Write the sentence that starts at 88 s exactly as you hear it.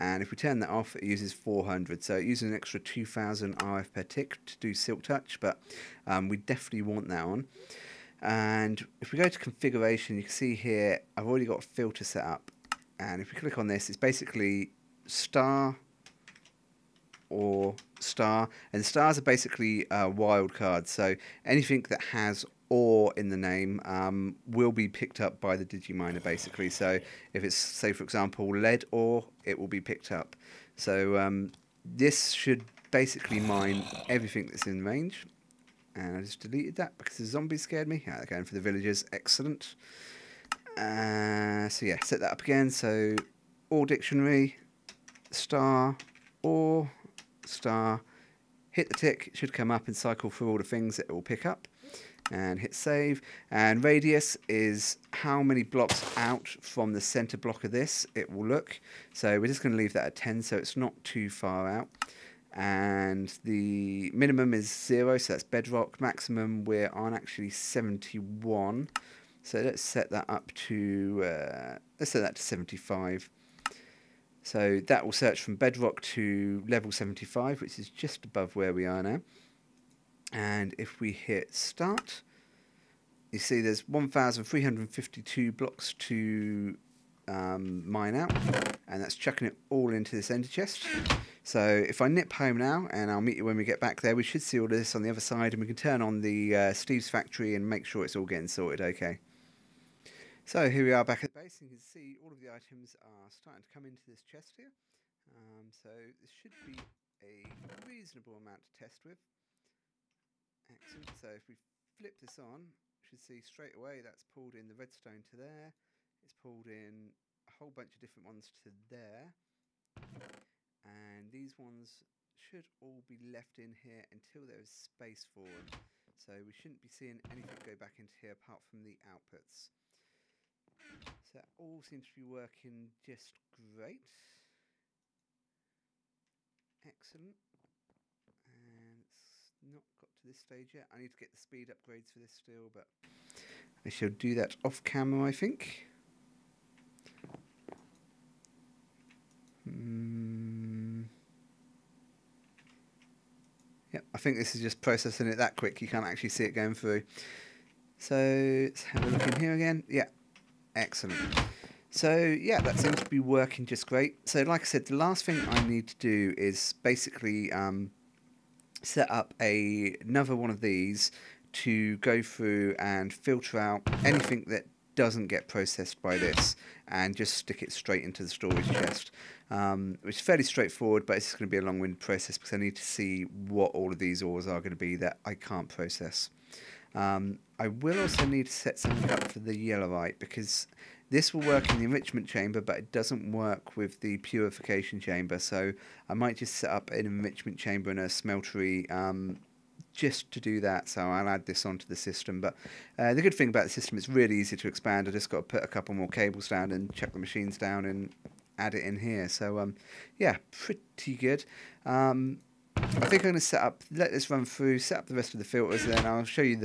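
And that's chucking it all into this ender chest.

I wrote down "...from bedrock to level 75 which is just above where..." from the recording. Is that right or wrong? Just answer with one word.
right.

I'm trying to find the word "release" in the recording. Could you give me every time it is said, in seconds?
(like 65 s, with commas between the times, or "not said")
not said.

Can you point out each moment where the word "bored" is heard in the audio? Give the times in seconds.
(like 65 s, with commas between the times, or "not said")
not said.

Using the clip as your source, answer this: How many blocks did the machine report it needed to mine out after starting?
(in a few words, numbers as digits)
1,352.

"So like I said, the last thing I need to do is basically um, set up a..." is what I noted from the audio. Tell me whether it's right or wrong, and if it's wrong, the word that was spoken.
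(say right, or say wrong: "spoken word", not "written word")
right.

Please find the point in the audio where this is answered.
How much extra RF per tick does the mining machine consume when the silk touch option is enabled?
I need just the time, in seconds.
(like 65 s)
2 s.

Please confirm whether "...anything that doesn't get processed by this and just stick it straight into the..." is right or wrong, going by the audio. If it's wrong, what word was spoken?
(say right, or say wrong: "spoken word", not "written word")
right.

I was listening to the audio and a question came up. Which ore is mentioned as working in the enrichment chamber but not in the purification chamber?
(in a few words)
Yellorite.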